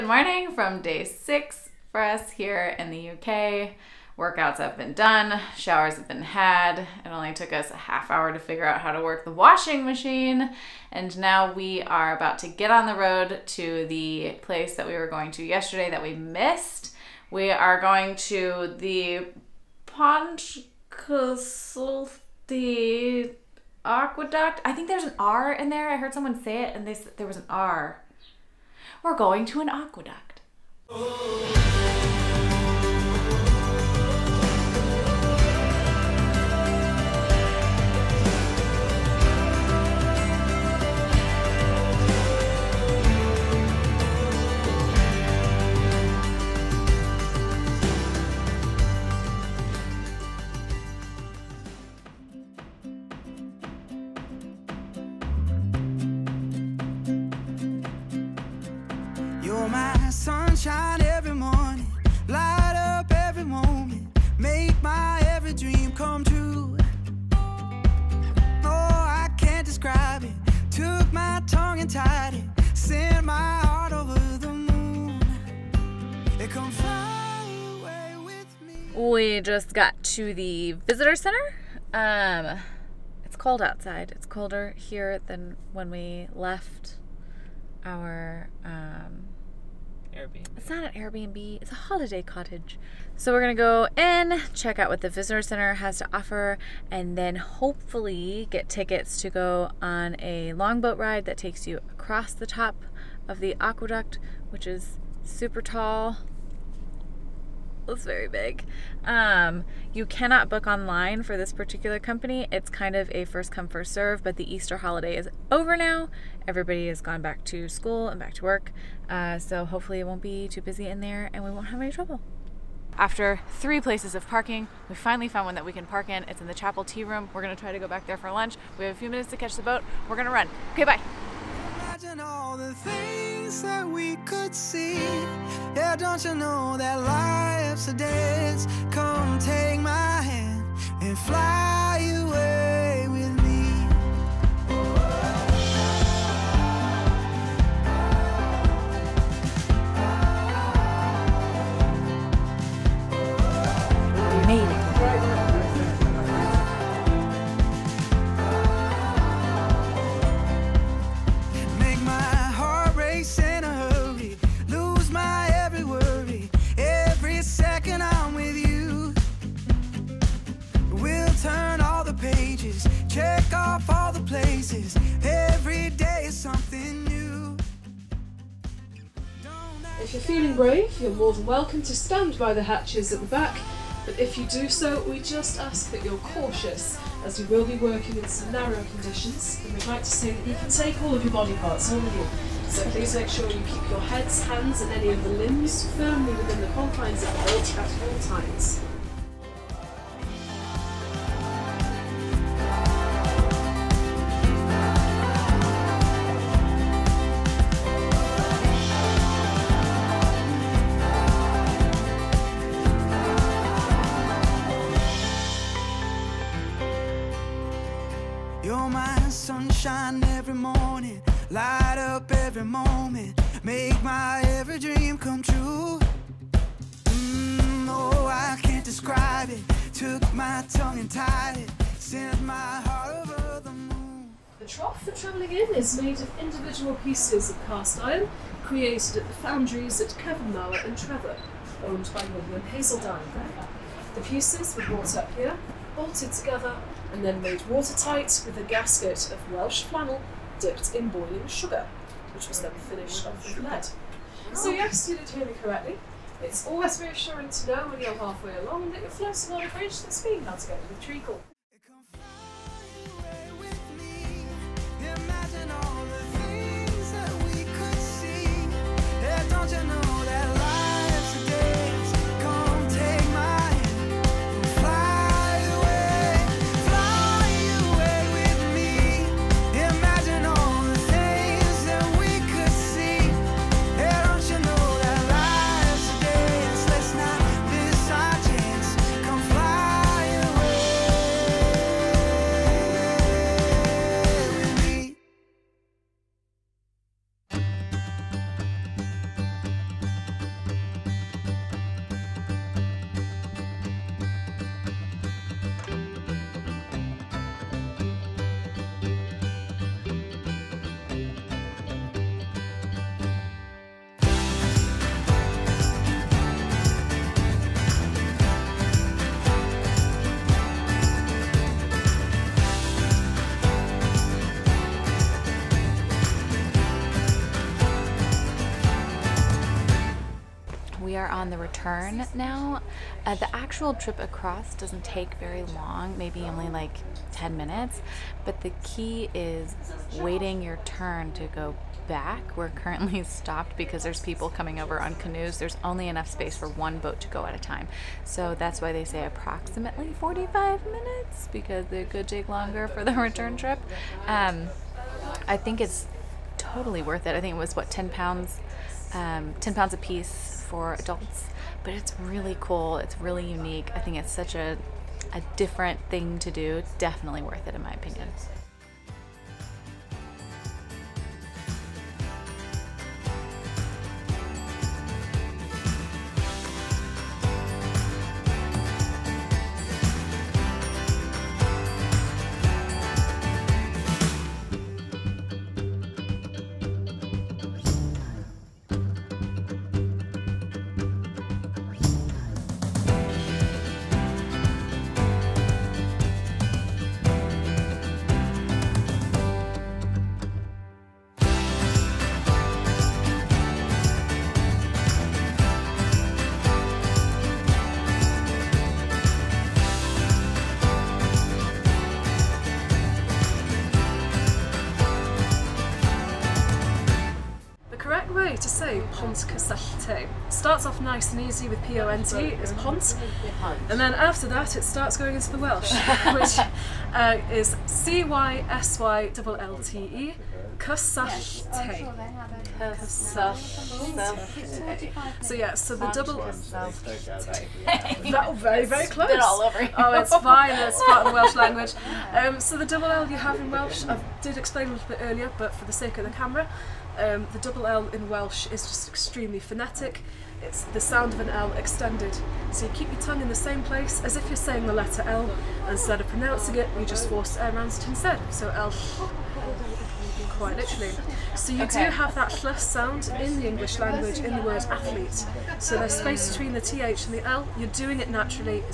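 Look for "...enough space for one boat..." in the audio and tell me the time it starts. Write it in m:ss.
5:46.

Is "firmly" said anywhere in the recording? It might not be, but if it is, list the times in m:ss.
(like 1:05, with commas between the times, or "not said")
3:15.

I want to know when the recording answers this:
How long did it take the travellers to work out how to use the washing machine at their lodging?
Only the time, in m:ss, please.
0:07.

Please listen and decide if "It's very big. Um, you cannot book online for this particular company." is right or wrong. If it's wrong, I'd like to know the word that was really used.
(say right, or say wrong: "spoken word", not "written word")
right.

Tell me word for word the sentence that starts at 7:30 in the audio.
It's the sound of an L extended.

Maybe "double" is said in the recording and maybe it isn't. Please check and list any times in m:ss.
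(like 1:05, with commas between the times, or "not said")
7:16, 7:22, 7:27.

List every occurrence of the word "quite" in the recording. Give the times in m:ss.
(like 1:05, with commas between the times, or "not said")
7:40.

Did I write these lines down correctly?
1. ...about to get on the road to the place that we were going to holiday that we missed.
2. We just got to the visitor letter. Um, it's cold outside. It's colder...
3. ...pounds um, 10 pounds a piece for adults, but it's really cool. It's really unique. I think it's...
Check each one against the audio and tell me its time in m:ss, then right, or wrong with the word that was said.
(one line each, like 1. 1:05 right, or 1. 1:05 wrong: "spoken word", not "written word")
1. 0:12 wrong: "yesterday", not "holiday"
2. 1:19 wrong: "center", not "letter"
3. 5:58 right.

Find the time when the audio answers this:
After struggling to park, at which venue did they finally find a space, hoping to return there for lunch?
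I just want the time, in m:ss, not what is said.
2:06.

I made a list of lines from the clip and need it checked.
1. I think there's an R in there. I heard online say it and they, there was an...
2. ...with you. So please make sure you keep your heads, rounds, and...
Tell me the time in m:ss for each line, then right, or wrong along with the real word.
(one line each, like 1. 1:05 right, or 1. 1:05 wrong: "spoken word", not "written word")
1. 0:24 wrong: "someone", not "online"
2. 3:12 wrong: "hands", not "rounds".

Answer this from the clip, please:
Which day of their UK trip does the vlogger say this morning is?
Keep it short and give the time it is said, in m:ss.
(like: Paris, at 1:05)
6, at 0:00.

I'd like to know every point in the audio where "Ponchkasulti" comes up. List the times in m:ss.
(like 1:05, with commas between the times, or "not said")
0:19.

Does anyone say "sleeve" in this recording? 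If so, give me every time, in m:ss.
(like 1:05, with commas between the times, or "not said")
not said.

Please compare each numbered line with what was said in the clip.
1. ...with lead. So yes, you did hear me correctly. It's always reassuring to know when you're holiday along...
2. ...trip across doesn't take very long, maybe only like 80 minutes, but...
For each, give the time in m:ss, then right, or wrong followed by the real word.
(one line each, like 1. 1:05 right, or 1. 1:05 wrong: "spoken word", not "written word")
1. 4:13 wrong: "halfway", not "holiday"
2. 5:33 wrong: "10", not "80".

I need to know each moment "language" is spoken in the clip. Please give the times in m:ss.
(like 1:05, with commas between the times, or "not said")
7:21, 7:43.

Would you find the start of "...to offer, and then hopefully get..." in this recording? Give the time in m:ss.
1:35.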